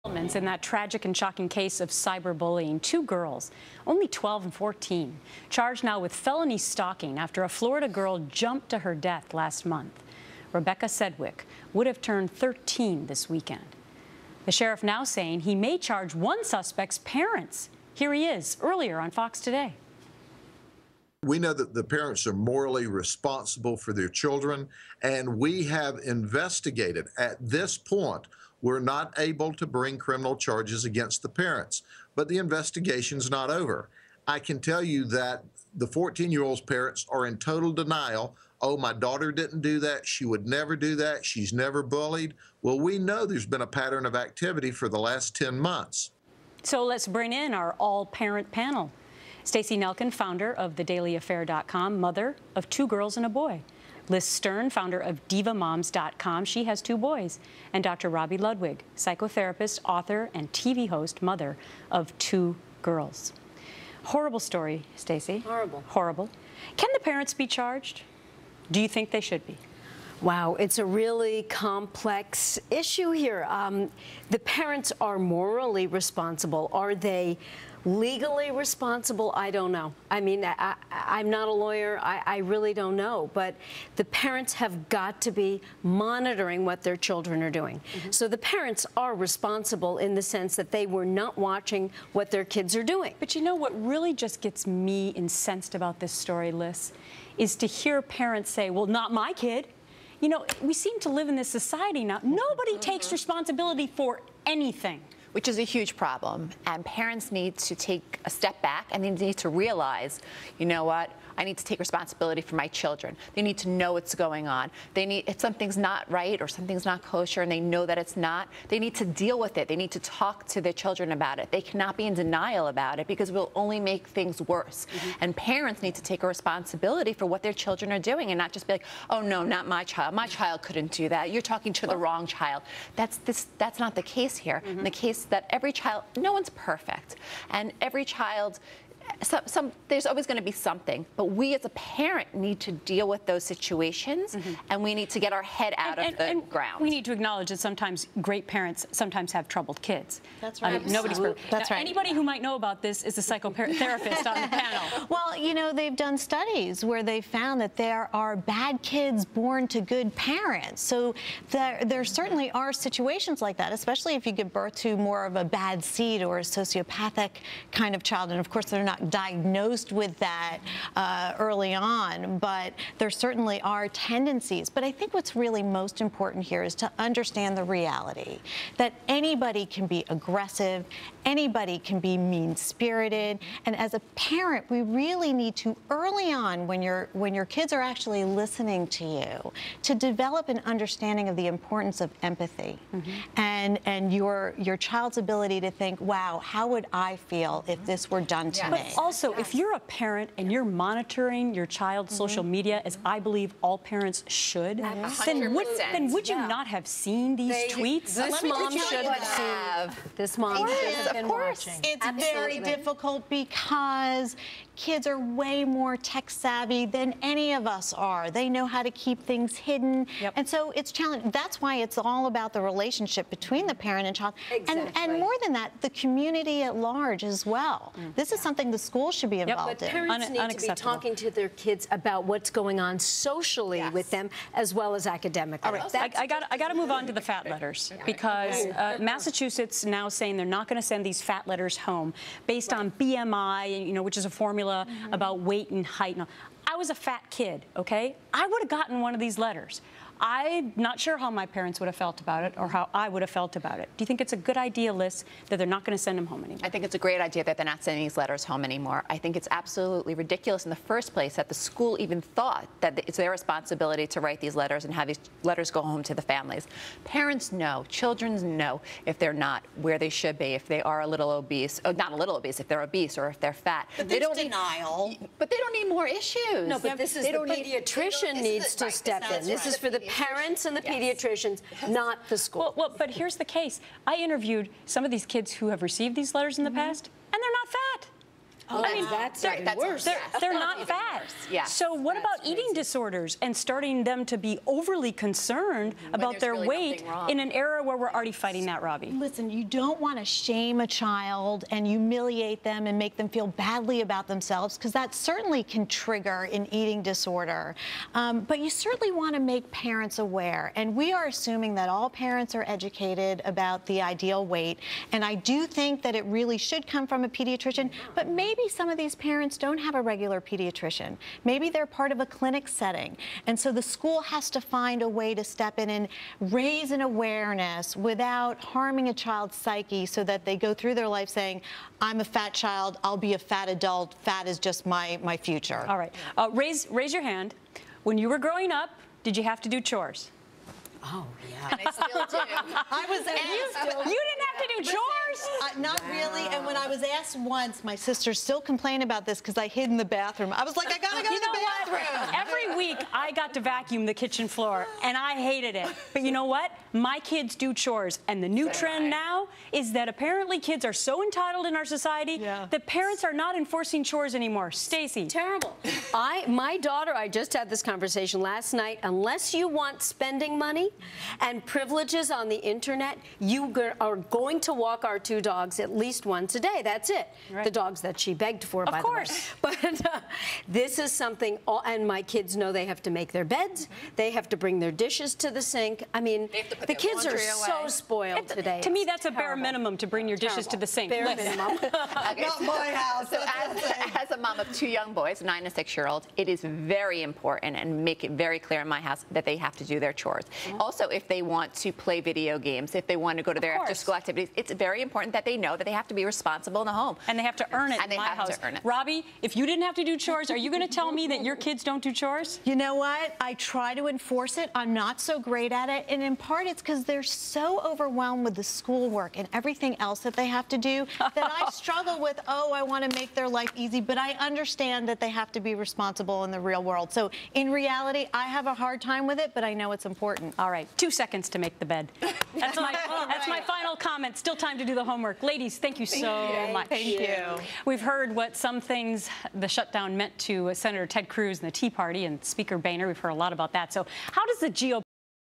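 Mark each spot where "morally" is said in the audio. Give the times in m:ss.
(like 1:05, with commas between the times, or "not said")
0:22, 1:15.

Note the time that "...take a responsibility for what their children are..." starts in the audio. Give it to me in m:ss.
2:06.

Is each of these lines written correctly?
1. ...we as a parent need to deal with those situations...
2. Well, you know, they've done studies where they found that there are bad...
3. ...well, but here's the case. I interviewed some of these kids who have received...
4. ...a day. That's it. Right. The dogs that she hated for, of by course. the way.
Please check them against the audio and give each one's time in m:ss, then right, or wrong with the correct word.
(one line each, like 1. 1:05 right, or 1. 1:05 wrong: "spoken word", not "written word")
1. 2:21 right
2. 2:35 right
3. 4:42 right
4. 6:16 wrong: "begged", not "hated".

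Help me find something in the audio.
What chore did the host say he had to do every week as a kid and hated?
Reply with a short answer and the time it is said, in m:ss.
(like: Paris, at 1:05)
vacuum the kitchen floor, at 5:53.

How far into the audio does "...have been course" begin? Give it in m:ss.
3:30.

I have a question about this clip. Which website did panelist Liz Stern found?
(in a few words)
divamoms.com.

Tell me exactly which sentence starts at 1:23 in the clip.
But the parents have got to be monitoring what their children are doing.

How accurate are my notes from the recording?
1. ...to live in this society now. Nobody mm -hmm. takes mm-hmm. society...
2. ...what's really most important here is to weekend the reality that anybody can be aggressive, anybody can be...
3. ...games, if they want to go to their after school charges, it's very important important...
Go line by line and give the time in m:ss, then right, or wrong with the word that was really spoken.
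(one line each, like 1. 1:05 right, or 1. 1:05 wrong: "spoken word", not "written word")
1. 1:40 wrong: "responsibility", not "society"
2. 2:55 wrong: "understand", not "weekend"
3. 6:42 wrong: "activities", not "charges".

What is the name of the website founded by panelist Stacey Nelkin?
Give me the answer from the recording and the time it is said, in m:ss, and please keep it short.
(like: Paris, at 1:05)
thedailyaffair.com, at 0:50.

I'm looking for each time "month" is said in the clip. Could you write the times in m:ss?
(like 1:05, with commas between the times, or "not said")
0:09, 0:45.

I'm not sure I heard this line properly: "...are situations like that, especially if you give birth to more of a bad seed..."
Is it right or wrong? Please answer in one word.
right.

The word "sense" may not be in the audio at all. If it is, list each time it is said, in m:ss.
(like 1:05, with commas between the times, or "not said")
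1:30.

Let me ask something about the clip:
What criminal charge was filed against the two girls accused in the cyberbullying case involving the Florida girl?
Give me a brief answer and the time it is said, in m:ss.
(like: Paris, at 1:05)
felony stalking, at 0:06.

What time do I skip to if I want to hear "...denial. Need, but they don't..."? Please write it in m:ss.
4:34.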